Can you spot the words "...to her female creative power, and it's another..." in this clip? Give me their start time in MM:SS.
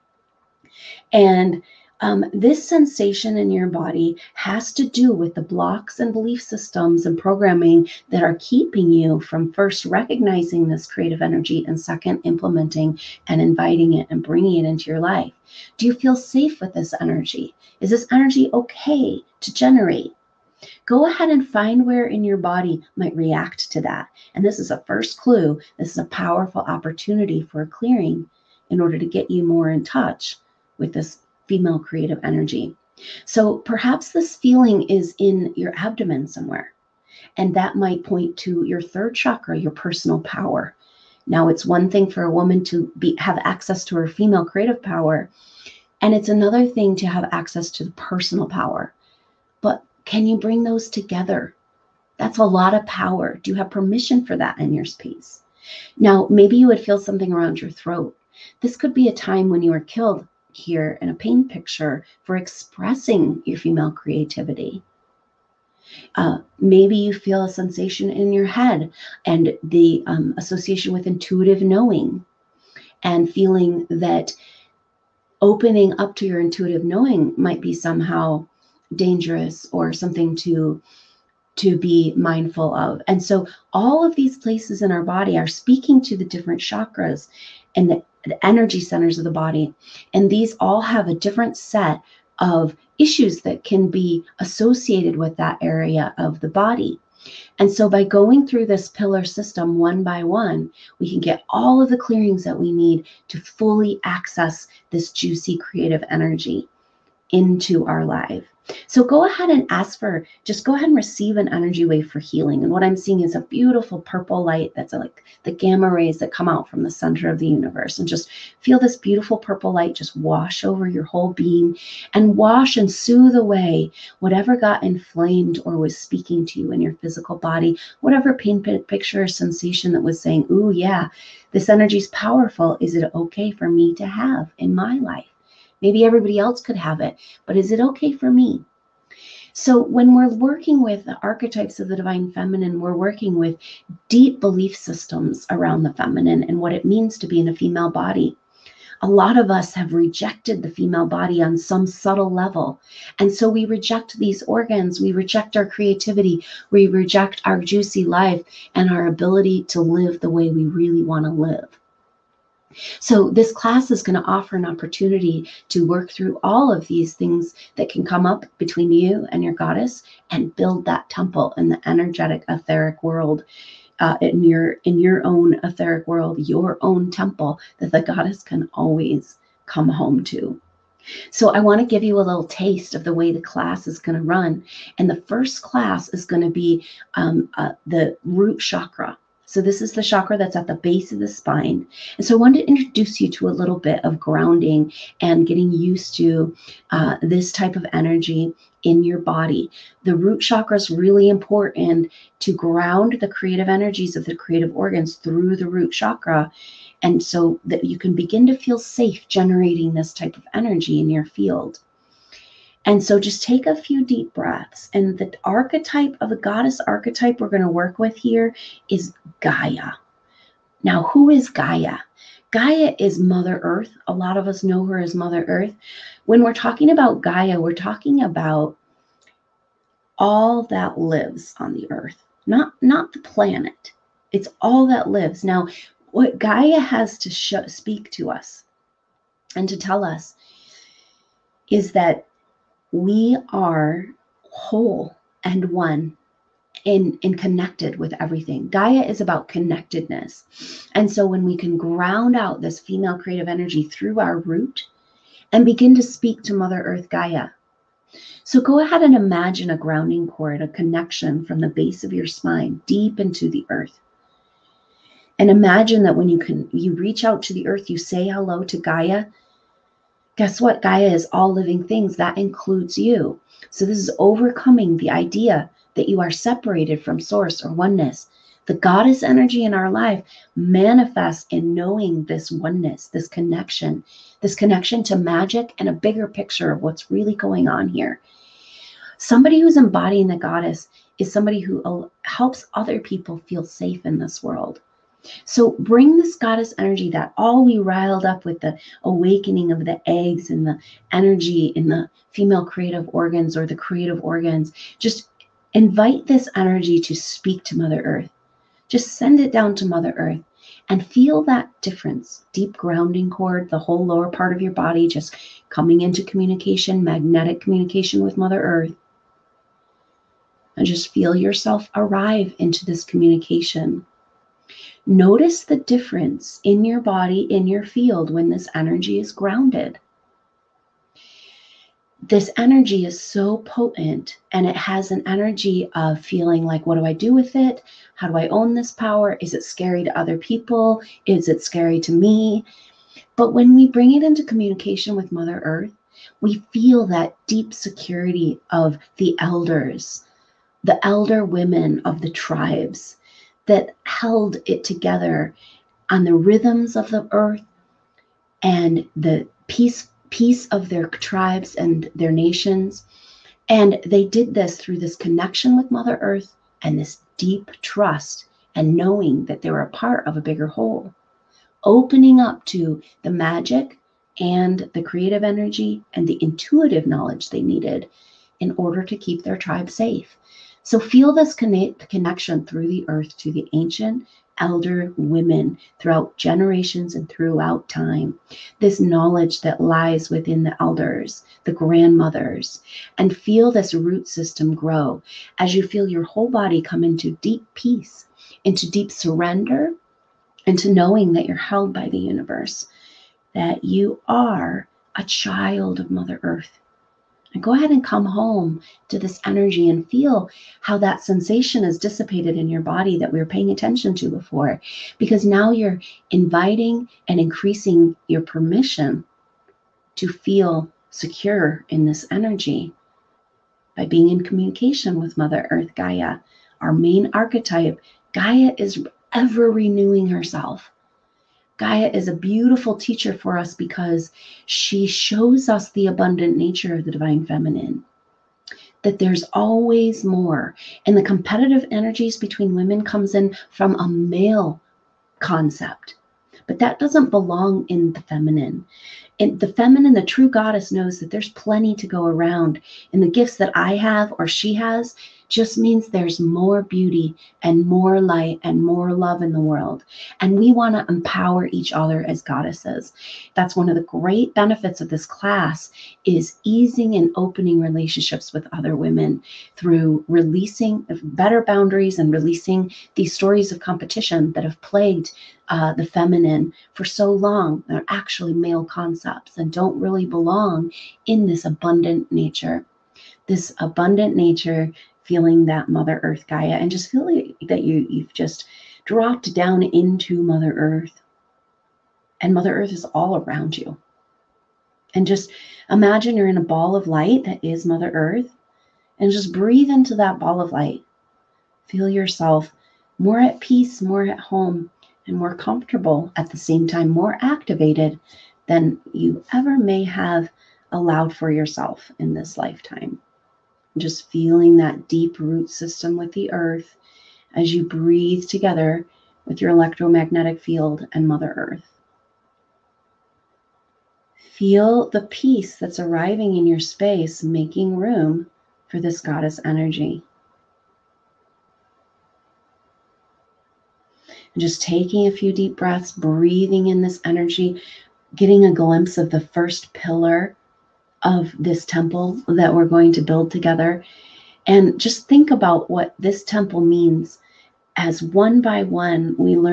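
00:43.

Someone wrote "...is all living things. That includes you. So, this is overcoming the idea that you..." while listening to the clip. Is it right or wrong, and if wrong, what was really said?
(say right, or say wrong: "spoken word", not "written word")
right.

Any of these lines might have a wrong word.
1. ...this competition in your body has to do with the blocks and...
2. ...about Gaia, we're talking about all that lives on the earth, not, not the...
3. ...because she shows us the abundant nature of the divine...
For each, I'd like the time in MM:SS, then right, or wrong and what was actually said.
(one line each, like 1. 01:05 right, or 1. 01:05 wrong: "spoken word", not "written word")
1. 00:02 wrong: "sensation", not "competition"
2. 03:46 right
3. 07:13 right.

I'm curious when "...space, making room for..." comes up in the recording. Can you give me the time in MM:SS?
08:46.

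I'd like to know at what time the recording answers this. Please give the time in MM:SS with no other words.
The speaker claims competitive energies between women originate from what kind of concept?
07:23.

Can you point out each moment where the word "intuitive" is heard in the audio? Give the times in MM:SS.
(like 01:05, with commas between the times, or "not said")
01:11, 01:16, 06:16.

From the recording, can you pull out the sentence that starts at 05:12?
Deep grounding cord, the whole lower part of your body just coming into communication, magnetic communication with Mother Earth.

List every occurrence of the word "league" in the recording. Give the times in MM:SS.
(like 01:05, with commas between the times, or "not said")
not said.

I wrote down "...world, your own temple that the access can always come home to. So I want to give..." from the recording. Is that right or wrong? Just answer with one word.
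wrong.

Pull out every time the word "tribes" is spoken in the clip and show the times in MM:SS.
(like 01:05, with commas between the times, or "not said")
05:52, 06:01, 06:19.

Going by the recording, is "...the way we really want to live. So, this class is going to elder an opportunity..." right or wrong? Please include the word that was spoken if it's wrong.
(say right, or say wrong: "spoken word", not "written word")
wrong: "offer", not "elder".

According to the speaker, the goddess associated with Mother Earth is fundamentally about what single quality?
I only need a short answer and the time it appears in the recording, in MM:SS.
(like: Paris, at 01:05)
connectedness, at 04:09.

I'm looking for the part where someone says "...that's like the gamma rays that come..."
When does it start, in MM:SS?
01:54.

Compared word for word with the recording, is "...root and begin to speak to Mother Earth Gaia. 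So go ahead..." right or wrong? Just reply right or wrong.
right.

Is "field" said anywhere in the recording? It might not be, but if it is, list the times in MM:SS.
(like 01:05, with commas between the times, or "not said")
03:31, 05:27, 08:40.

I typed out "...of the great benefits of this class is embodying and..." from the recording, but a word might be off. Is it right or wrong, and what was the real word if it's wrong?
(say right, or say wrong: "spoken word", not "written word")
wrong: "easing", not "embodying".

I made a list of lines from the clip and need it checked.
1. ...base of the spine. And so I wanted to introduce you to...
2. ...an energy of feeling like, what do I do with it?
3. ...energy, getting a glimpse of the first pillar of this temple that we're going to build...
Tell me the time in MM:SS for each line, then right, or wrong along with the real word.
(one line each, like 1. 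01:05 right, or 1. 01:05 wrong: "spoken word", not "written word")
1. 03:10 right
2. 05:35 right
3. 08:57 right.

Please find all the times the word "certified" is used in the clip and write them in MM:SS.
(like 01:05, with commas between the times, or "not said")
not said.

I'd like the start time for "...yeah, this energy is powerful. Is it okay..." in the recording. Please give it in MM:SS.
02:10.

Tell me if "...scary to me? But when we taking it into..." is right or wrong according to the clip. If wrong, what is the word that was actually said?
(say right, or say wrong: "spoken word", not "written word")
wrong: "bring", not "taking".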